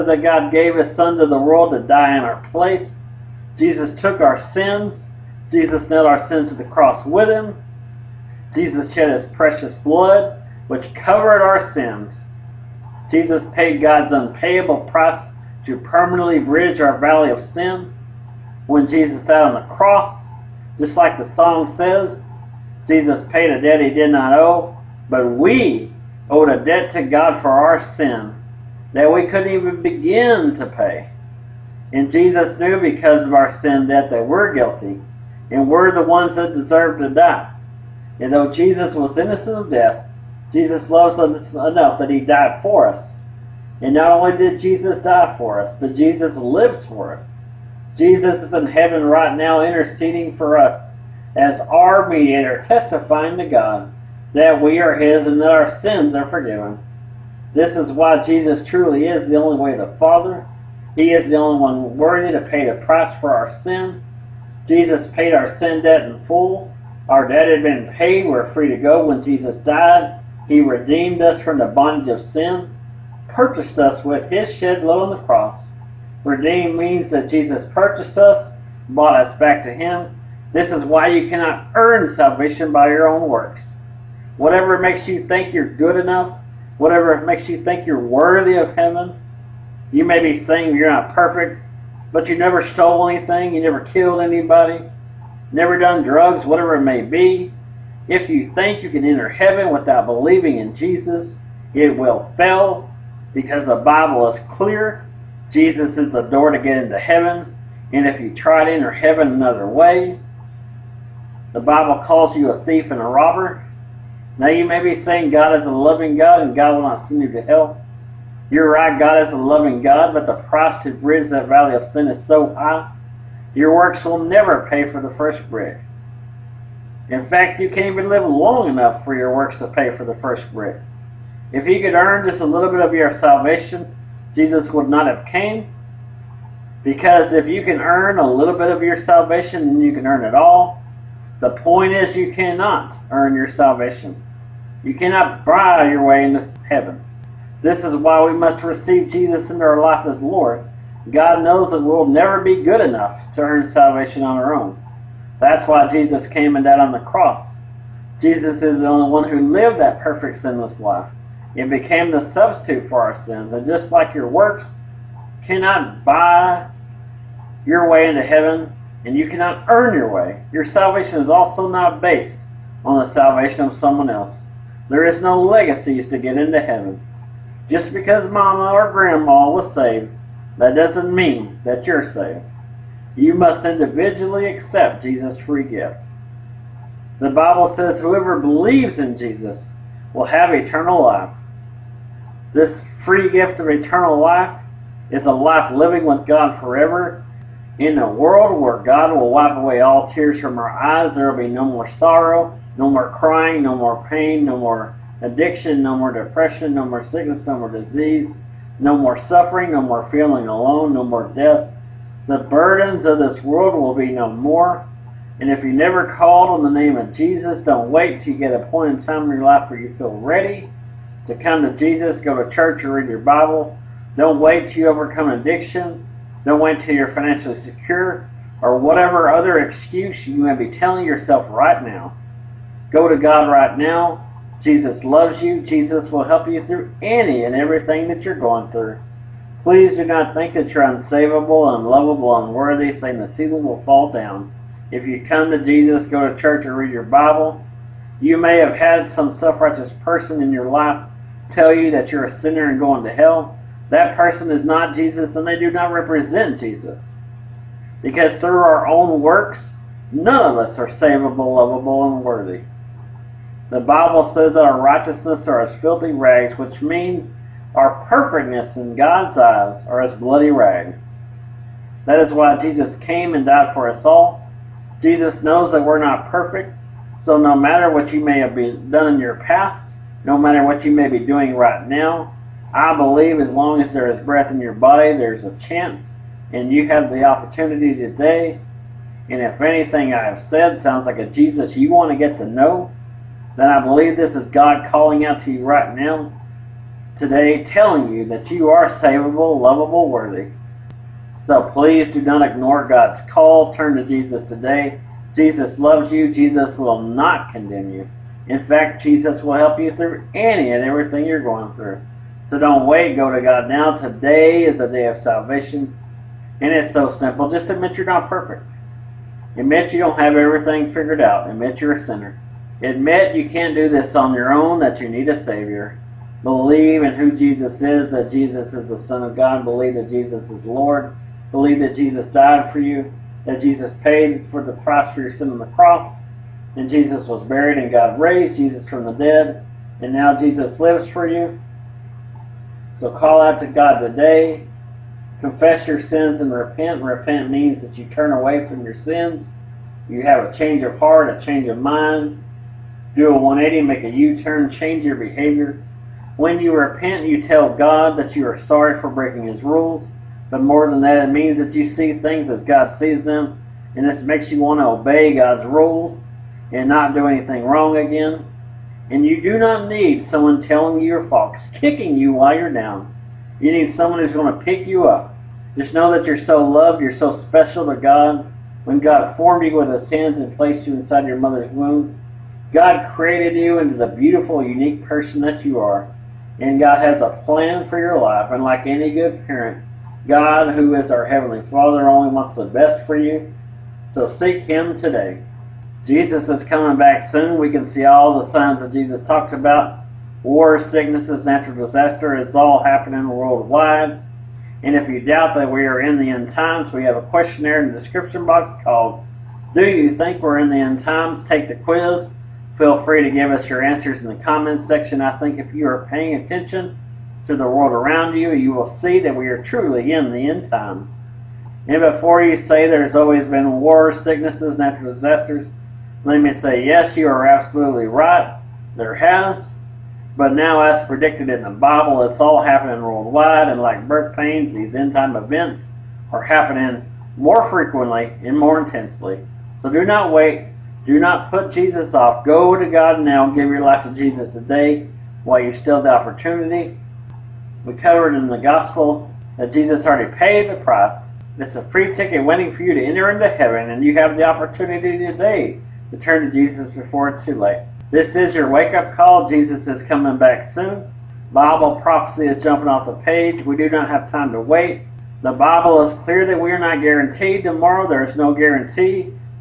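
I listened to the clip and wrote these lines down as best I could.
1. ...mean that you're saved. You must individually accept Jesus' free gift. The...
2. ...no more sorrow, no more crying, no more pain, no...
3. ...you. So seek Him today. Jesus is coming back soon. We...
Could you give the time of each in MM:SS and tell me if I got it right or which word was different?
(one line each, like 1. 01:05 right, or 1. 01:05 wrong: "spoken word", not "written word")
1. 03:01 right
2. 03:21 right
3. 06:33 right.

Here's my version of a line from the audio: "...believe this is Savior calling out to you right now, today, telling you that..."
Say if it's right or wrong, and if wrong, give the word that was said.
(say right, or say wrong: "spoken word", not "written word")
wrong: "God", not "Savior".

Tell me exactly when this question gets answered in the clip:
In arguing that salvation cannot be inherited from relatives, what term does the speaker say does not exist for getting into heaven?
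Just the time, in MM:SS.
02:55.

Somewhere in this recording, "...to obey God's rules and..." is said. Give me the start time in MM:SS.
06:04.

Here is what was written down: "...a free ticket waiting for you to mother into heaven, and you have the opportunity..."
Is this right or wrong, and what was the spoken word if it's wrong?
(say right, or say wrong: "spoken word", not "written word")
wrong: "enter", not "mother".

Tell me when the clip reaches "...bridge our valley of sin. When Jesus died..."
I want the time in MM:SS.
00:16.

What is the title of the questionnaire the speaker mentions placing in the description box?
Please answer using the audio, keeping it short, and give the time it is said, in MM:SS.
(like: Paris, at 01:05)
Do You Think We're in the End Times?, at 06:49.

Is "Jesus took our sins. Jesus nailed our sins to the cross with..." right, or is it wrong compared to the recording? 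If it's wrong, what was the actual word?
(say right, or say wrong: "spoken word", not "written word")
right.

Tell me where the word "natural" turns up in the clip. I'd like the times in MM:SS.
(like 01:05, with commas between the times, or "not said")
06:41, 07:04.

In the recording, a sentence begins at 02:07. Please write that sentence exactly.
In fact, you can't even live long enough for your works to pay for the first brick.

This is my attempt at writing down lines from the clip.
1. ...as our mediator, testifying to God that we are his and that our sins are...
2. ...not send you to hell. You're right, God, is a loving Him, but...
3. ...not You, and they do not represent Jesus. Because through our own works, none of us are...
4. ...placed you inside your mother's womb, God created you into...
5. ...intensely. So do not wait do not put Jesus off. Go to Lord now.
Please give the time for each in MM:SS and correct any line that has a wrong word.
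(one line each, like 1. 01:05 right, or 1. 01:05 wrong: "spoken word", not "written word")
1. 00:51 right
2. 01:56 wrong: "God", not "Him"
3. 04:14 wrong: "Jesus", not "You"
4. 06:20 right
5. 07:18 wrong: "God", not "Lord".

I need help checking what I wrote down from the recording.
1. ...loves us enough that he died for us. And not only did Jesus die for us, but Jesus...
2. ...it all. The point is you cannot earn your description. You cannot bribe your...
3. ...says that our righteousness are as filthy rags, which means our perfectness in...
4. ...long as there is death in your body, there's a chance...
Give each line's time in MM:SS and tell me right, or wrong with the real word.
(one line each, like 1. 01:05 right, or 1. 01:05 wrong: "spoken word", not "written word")
1. 00:40 right
2. 02:20 wrong: "salvation", not "description"
3. 04:24 right
4. 04:43 wrong: "breath", not "death".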